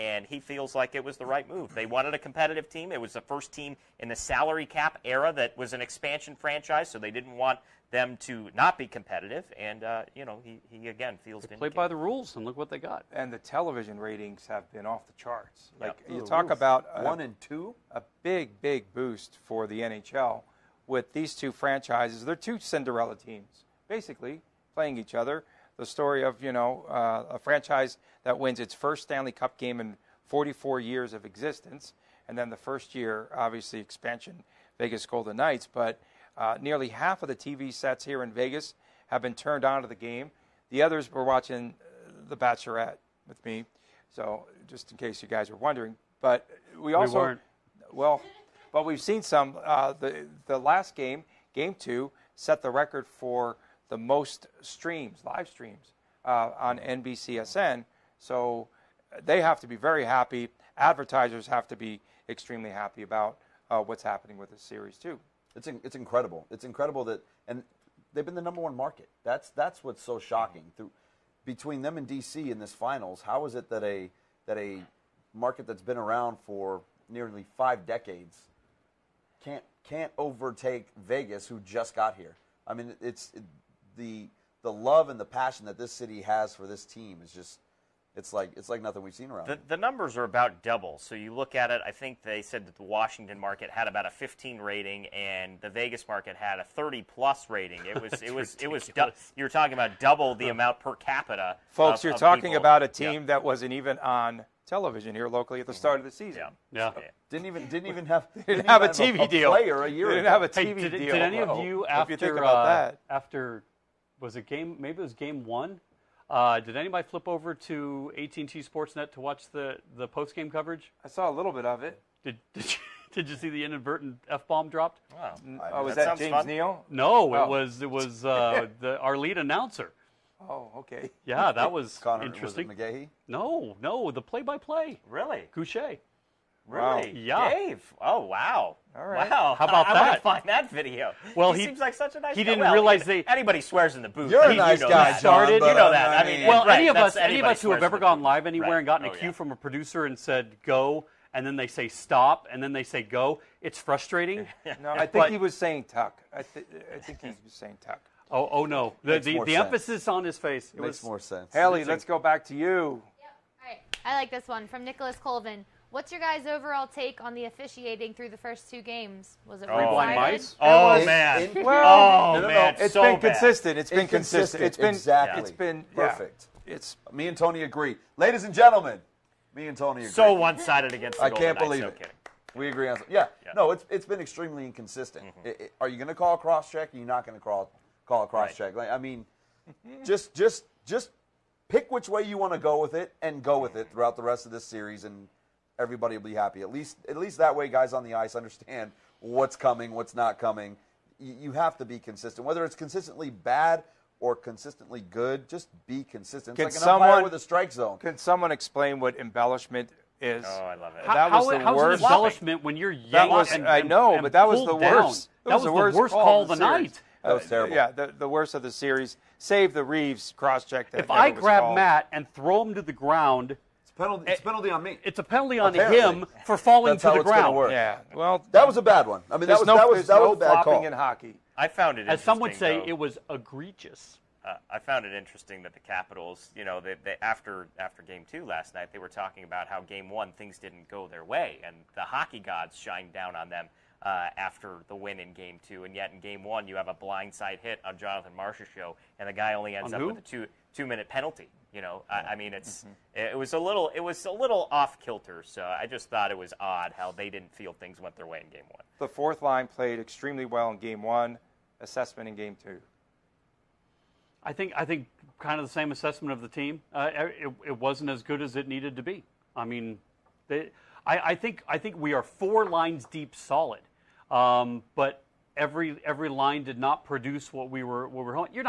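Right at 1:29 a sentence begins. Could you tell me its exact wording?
The, the, numbers are about double.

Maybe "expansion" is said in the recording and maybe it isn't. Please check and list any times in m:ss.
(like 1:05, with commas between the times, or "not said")
0:05, 0:33.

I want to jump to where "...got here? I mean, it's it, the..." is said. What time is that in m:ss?
1:21.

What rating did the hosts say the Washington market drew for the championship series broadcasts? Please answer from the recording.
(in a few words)
15.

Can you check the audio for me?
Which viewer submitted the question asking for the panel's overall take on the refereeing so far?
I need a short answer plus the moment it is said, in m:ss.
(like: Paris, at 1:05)
Nicholas Colvin, at 2:44.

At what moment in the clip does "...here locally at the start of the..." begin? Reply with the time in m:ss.
1:45.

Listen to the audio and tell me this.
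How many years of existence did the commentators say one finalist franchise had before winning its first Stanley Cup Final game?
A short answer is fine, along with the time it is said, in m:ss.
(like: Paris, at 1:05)
44, at 0:30.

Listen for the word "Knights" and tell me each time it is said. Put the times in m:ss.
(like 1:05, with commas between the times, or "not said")
0:35, 3:01.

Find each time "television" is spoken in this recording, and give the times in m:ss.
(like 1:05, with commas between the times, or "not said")
0:13, 1:44.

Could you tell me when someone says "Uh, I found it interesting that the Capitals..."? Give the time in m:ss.
3:54.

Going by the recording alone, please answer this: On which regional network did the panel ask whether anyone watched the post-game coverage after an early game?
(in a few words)
AT&T Sportsnet.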